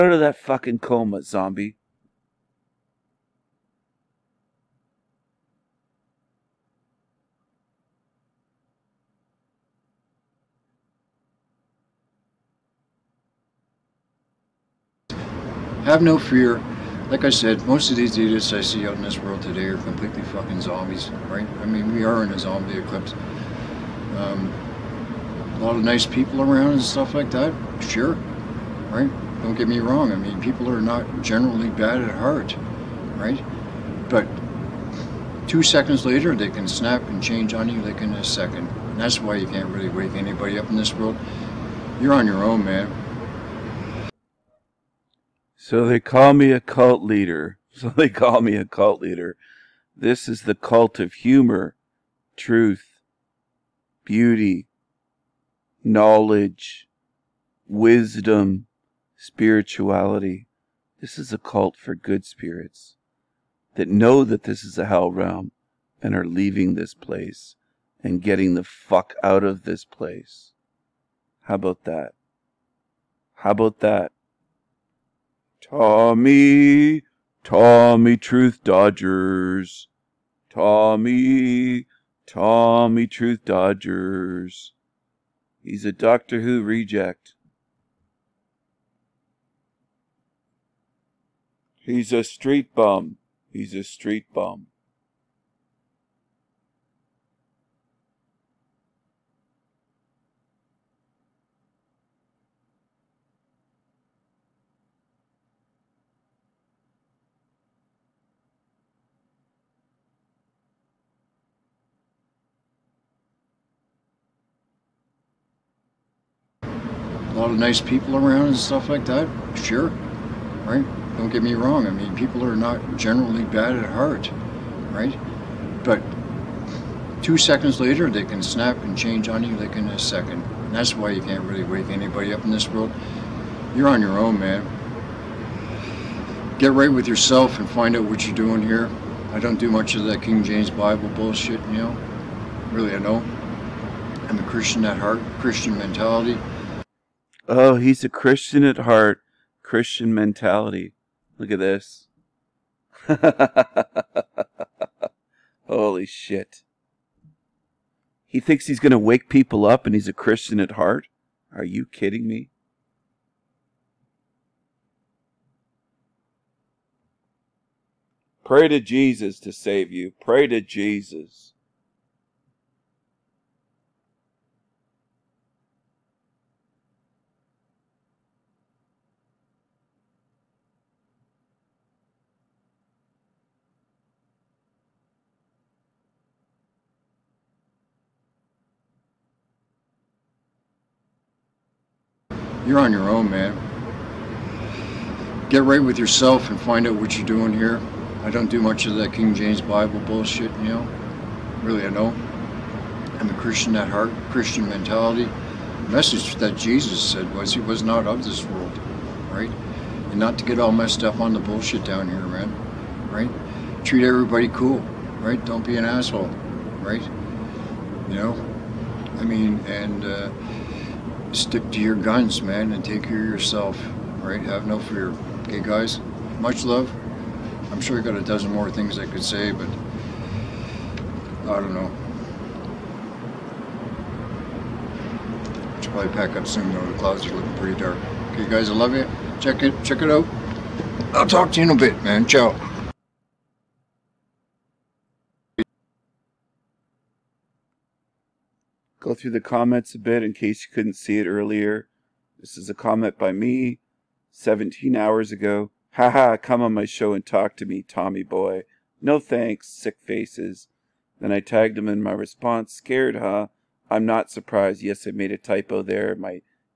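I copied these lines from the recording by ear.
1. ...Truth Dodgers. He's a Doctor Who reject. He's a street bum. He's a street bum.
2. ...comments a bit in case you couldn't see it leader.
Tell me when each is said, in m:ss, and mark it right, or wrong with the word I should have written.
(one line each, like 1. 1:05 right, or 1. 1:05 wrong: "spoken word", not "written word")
1. 1:23 right
2. 4:09 wrong: "earlier", not "leader".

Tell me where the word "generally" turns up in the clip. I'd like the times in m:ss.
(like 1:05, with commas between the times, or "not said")
0:31, 2:02.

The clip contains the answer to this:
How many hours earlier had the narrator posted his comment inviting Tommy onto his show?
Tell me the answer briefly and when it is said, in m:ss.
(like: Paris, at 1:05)
17, at 4:14.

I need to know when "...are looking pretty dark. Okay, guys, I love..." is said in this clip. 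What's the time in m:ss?
3:57.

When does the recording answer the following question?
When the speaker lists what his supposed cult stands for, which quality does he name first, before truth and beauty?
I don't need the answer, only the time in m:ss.
0:51.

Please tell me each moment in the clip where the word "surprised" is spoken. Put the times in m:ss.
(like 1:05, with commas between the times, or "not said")
4:24.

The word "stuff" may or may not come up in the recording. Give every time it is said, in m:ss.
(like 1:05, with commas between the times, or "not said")
0:26, 1:58.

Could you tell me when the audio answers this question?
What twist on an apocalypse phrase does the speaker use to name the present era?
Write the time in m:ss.
0:22.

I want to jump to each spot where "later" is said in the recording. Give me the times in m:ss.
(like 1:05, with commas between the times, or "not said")
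0:36, 2:07.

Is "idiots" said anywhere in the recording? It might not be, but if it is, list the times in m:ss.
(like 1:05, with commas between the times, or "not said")
0:18.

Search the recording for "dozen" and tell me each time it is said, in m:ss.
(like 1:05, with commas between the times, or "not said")
3:48.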